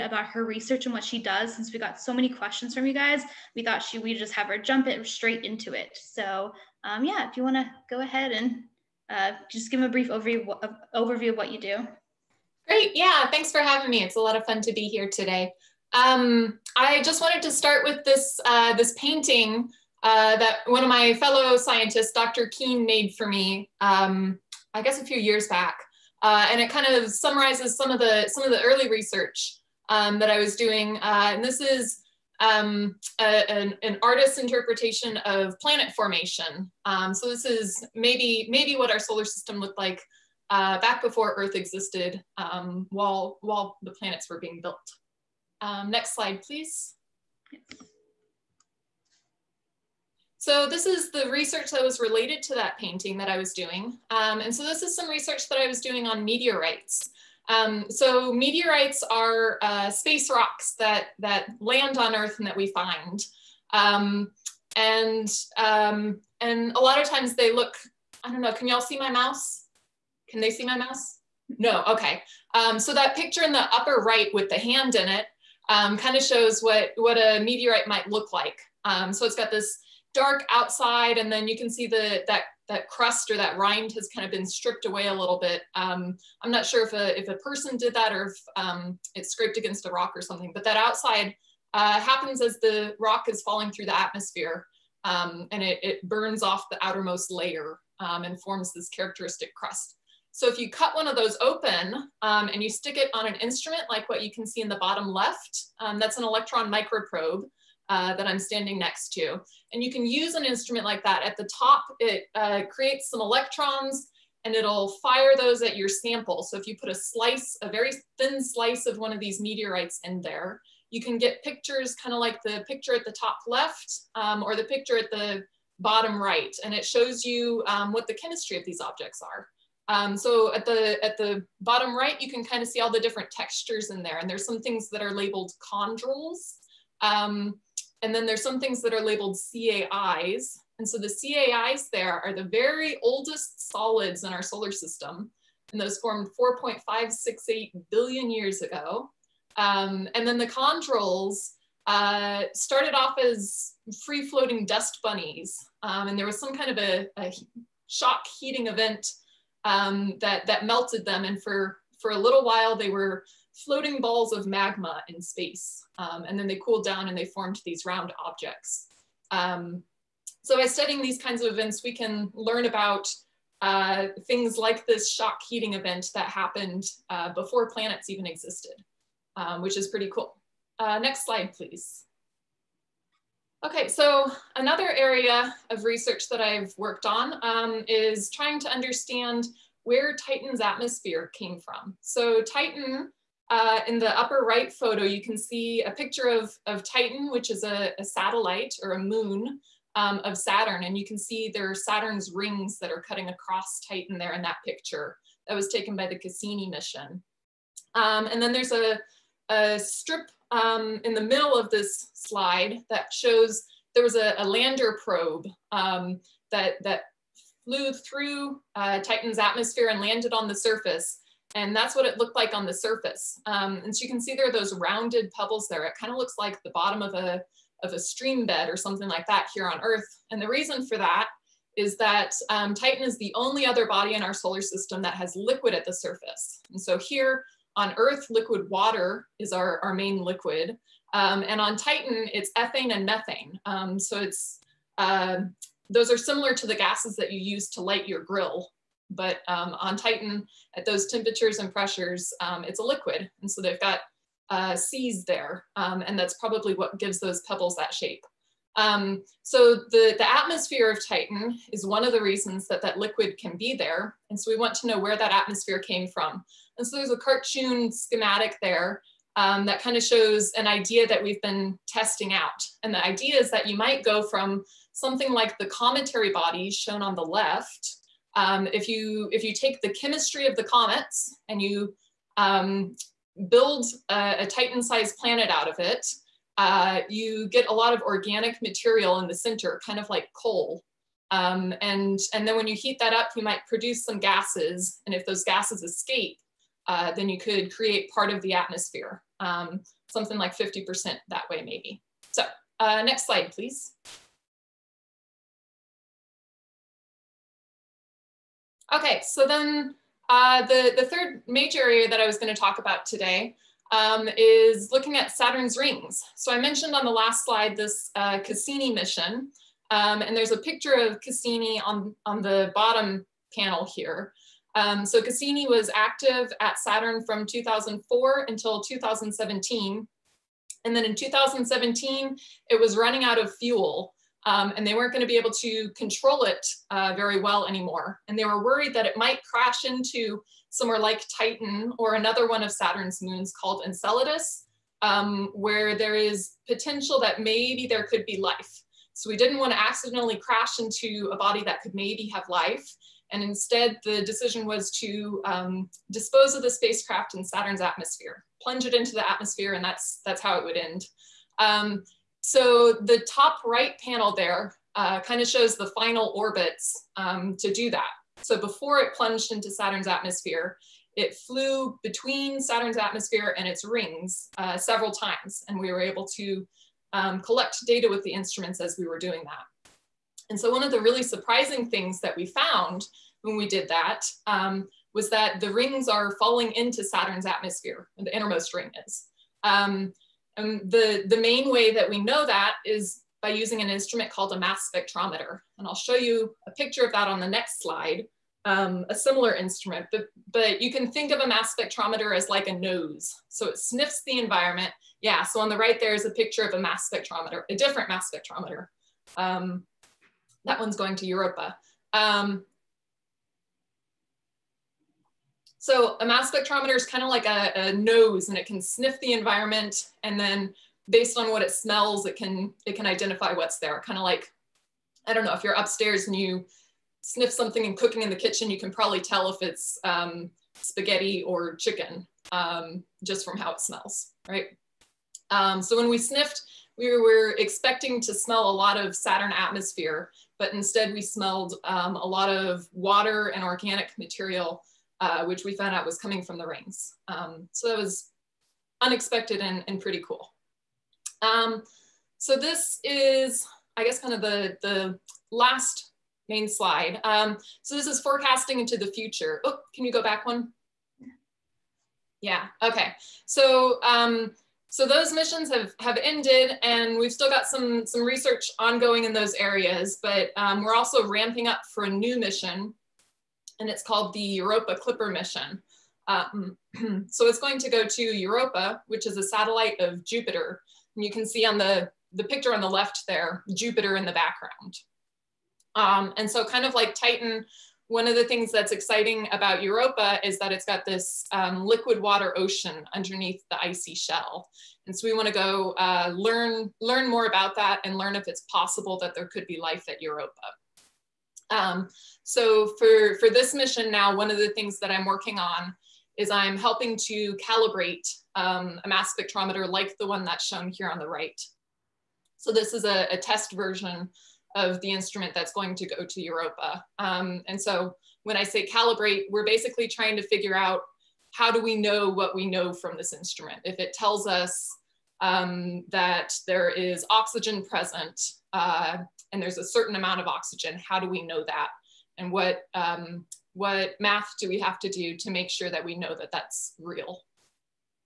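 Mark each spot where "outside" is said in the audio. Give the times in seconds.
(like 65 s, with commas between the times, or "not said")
80 s, 90 s.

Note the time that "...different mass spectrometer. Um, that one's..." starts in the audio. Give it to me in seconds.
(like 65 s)
407 s.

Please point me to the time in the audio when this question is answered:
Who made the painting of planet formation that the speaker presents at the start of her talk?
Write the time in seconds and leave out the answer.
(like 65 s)
22 s.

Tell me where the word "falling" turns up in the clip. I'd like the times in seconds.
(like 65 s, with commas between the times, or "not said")
93 s, 386 s.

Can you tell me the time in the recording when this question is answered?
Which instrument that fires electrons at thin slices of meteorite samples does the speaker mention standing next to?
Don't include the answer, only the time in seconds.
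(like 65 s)
106 s.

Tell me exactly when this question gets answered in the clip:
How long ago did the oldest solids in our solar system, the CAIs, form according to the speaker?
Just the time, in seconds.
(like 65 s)
146 s.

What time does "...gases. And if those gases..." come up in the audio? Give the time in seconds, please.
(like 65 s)
294 s.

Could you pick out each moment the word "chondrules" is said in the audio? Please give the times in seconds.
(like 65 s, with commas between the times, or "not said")
135 s, 150 s.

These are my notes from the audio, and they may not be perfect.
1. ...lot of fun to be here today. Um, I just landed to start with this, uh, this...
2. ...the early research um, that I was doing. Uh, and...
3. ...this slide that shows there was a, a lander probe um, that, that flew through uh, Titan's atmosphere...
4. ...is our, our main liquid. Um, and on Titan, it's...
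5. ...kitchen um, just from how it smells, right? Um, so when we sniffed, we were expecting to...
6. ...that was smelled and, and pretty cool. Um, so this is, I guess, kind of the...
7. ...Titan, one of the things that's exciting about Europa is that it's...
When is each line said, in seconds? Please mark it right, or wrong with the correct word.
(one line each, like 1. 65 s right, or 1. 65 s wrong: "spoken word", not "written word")
1. 14 s wrong: "wanted", not "landed"
2. 28 s right
3. 211 s right
4. 239 s right
5. 431 s wrong: "chicken", not "kitchen"
6. 447 s wrong: "unexpected", not "smelled"
7. 487 s right.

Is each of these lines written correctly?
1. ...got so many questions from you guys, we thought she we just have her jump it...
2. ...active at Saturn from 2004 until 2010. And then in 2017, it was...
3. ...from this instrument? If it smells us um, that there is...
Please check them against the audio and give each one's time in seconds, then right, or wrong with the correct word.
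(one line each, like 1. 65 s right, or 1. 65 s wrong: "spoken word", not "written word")
1. 1 s right
2. 325 s wrong: "2017", not "2010"
3. 522 s wrong: "tells", not "smells".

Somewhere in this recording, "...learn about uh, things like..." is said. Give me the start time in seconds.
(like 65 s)
172 s.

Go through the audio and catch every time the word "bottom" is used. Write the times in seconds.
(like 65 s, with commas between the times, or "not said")
104 s, 125 s, 131 s, 226 s, 322 s.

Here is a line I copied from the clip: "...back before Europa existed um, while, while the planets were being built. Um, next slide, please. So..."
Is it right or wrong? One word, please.
wrong.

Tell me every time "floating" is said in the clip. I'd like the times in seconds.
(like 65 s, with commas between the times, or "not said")
154 s, 163 s.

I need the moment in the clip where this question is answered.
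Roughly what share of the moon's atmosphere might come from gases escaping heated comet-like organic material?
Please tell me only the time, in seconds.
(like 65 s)
300 s.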